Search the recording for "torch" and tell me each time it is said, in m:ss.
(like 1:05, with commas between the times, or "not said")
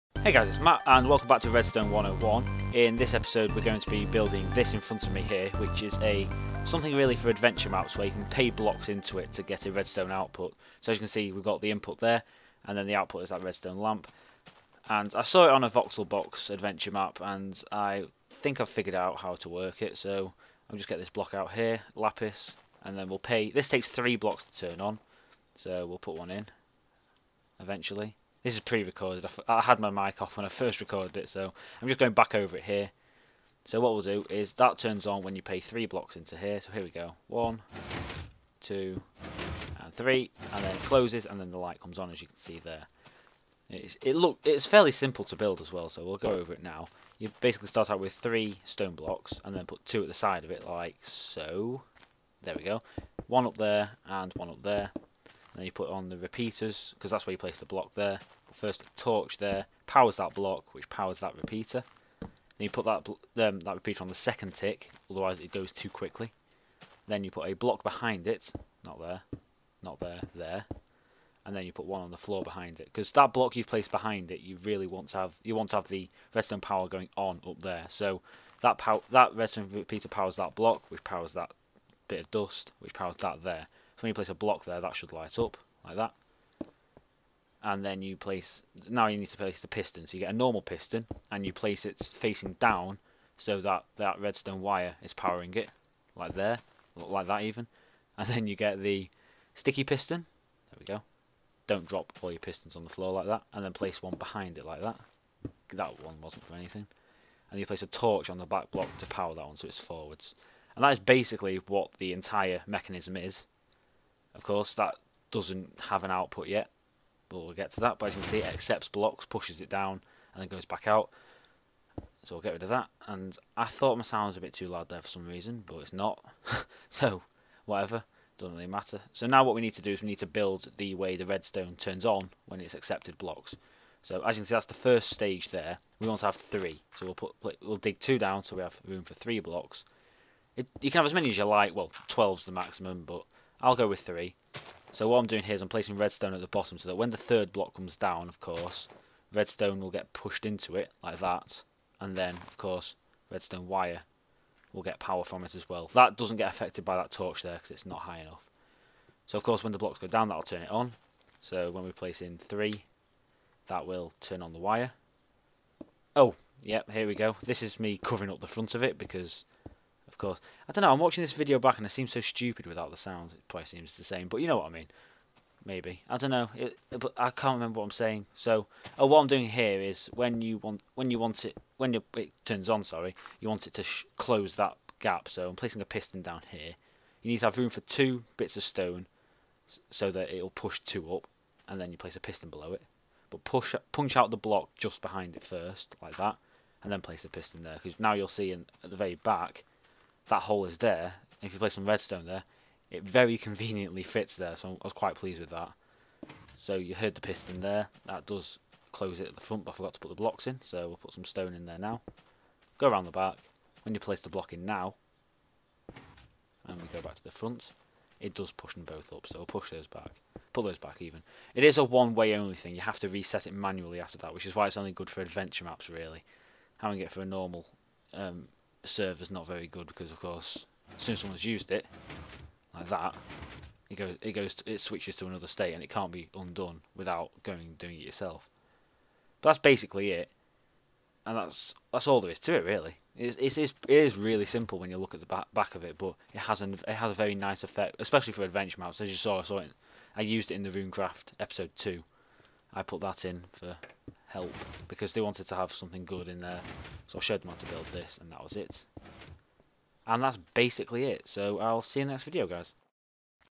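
0:58, 1:47, 2:37.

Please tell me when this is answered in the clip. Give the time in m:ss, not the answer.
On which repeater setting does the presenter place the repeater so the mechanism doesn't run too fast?
1:04.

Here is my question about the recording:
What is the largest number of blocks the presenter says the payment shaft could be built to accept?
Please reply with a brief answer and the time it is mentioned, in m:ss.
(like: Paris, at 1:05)
12, at 2:22.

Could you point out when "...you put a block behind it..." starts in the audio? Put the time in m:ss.
1:07.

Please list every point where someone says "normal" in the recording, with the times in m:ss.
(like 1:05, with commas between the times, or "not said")
1:30, 3:47.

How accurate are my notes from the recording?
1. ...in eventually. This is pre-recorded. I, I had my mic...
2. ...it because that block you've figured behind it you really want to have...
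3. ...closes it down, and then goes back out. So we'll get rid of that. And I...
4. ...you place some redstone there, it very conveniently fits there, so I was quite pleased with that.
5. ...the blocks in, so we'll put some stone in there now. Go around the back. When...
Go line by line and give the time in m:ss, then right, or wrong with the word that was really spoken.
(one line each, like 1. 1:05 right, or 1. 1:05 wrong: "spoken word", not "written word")
1. 0:26 right
2. 1:12 wrong: "placed", not "figured"
3. 1:59 wrong: "pushes", not "closes"
4. 3:21 right
5. 3:30 right.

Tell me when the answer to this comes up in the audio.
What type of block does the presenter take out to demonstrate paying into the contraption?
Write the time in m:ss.
0:21.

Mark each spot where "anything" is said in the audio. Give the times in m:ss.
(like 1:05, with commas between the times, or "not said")
1:46.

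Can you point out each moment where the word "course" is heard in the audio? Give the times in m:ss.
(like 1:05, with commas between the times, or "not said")
1:54, 2:28, 2:32, 2:39, 2:50, 3:50.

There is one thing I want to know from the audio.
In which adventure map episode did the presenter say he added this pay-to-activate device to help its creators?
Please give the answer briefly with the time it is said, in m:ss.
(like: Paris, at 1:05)
RuneCraft episode two, at 4:10.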